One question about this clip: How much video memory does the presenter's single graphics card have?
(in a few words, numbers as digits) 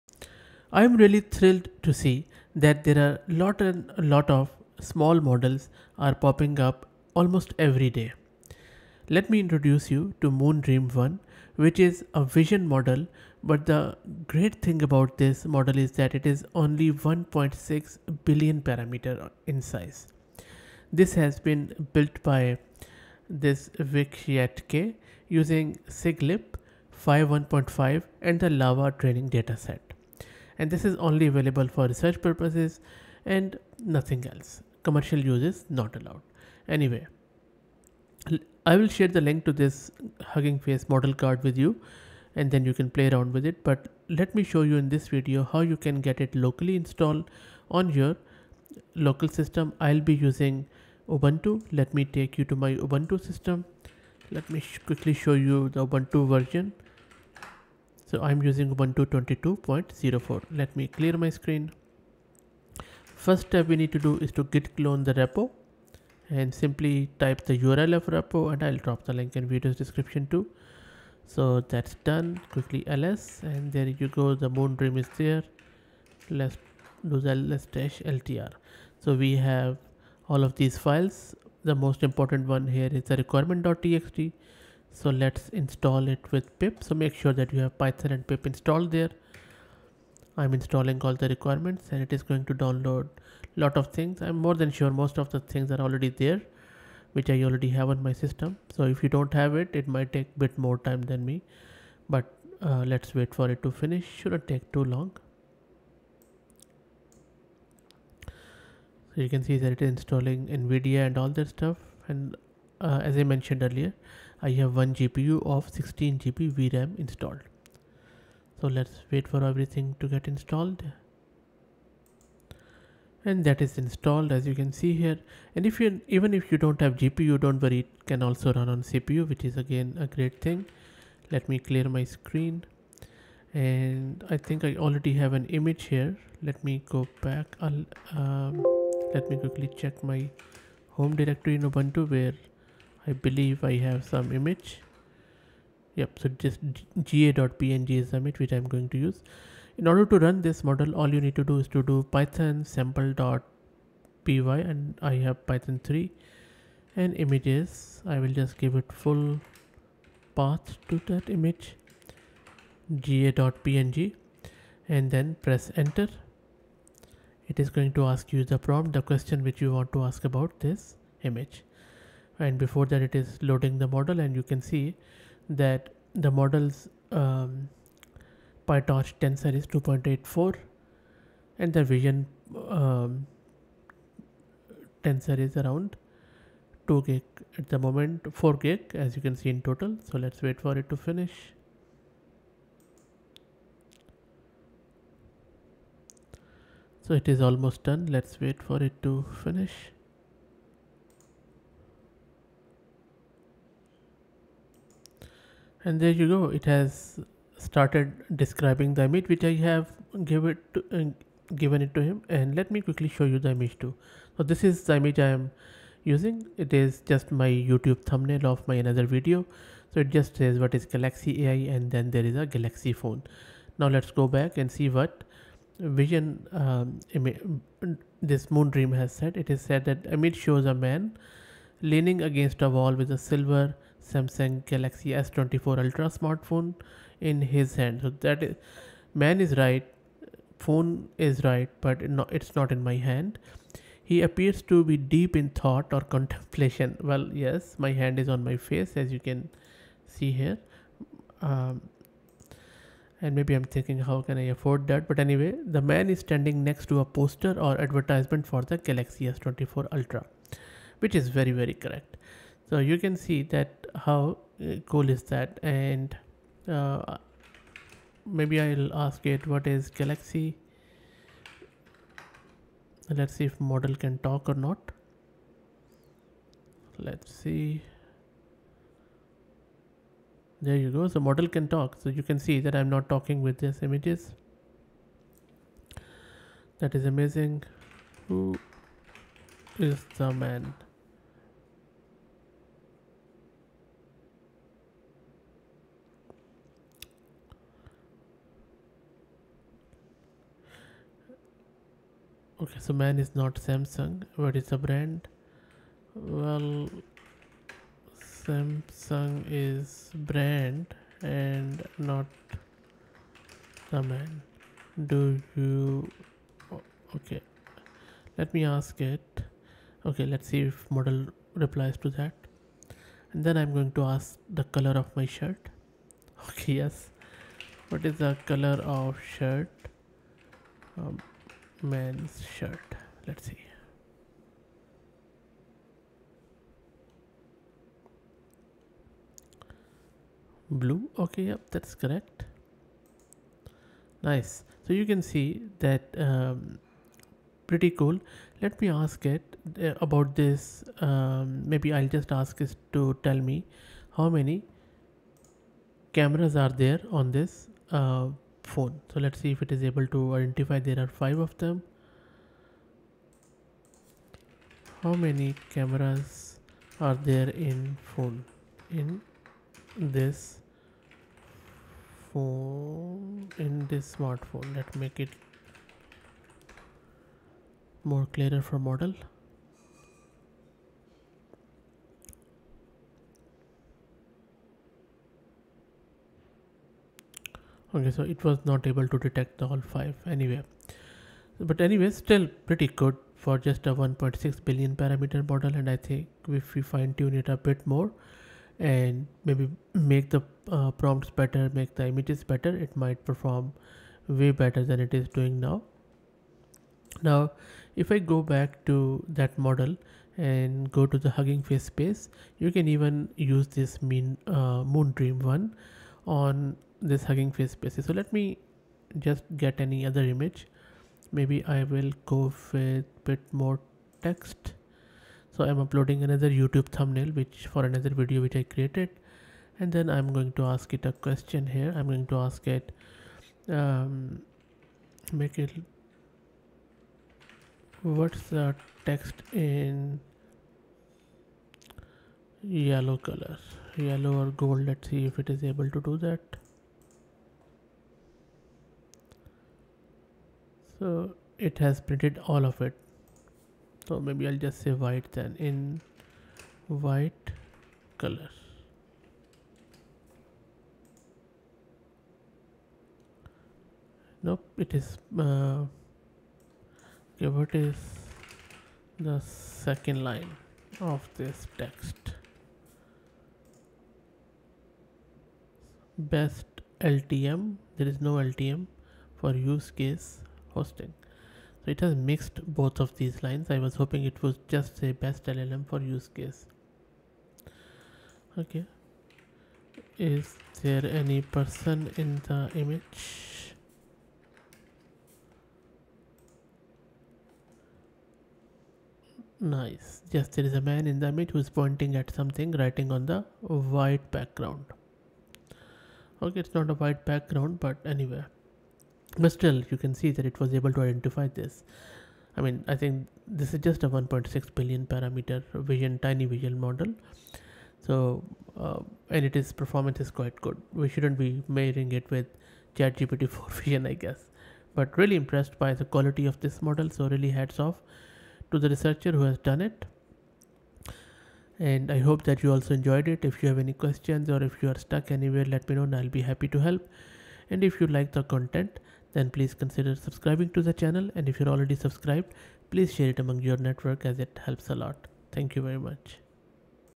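16 GB.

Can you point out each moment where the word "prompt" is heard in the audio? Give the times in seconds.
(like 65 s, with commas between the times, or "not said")
168 s, 400 s.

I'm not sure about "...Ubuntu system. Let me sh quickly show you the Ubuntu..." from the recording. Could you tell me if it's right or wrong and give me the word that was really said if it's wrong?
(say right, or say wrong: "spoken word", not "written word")
right.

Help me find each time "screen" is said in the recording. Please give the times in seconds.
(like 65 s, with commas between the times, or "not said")
61 s, 132 s.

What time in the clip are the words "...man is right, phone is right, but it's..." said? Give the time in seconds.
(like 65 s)
239 s.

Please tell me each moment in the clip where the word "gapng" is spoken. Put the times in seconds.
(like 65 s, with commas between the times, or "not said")
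147 s, 162 s.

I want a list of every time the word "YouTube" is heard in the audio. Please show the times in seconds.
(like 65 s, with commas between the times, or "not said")
217 s, 426 s.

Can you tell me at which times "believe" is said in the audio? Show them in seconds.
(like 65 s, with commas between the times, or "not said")
143 s.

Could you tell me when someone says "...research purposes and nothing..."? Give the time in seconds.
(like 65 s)
31 s.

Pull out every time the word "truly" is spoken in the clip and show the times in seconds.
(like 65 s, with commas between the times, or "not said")
not said.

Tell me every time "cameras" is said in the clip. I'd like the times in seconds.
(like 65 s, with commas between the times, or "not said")
356 s, 365 s.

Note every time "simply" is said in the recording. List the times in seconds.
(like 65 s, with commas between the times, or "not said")
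66 s.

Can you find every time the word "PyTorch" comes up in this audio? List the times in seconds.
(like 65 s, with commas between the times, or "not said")
178 s.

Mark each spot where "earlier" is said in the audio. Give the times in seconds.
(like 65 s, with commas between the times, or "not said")
113 s.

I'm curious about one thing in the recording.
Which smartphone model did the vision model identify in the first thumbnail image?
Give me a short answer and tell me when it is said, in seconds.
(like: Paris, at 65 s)
Samsung Galaxy S24 Ultra, at 234 s.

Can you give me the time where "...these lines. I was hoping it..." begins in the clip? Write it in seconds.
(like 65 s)
483 s.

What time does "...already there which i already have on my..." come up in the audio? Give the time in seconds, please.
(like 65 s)
95 s.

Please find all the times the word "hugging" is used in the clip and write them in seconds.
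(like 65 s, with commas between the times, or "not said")
40 s, 411 s, 417 s.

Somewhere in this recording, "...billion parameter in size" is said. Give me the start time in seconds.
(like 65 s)
18 s.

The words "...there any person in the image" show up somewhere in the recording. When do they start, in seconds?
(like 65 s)
490 s.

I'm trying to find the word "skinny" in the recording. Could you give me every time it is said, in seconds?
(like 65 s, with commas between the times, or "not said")
not said.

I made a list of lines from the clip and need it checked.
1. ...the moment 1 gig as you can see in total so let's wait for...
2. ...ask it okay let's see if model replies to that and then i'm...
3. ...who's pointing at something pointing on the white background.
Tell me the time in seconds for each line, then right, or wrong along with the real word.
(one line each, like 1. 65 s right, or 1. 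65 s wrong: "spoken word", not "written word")
1. 187 s wrong: "4", not "1"
2. 318 s right
3. 501 s wrong: "writing", not "pointing".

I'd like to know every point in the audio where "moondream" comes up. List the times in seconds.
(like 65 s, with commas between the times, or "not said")
10 s, 74 s, 228 s, 414 s.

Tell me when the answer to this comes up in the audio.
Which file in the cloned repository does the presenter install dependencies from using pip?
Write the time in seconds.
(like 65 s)
83 s.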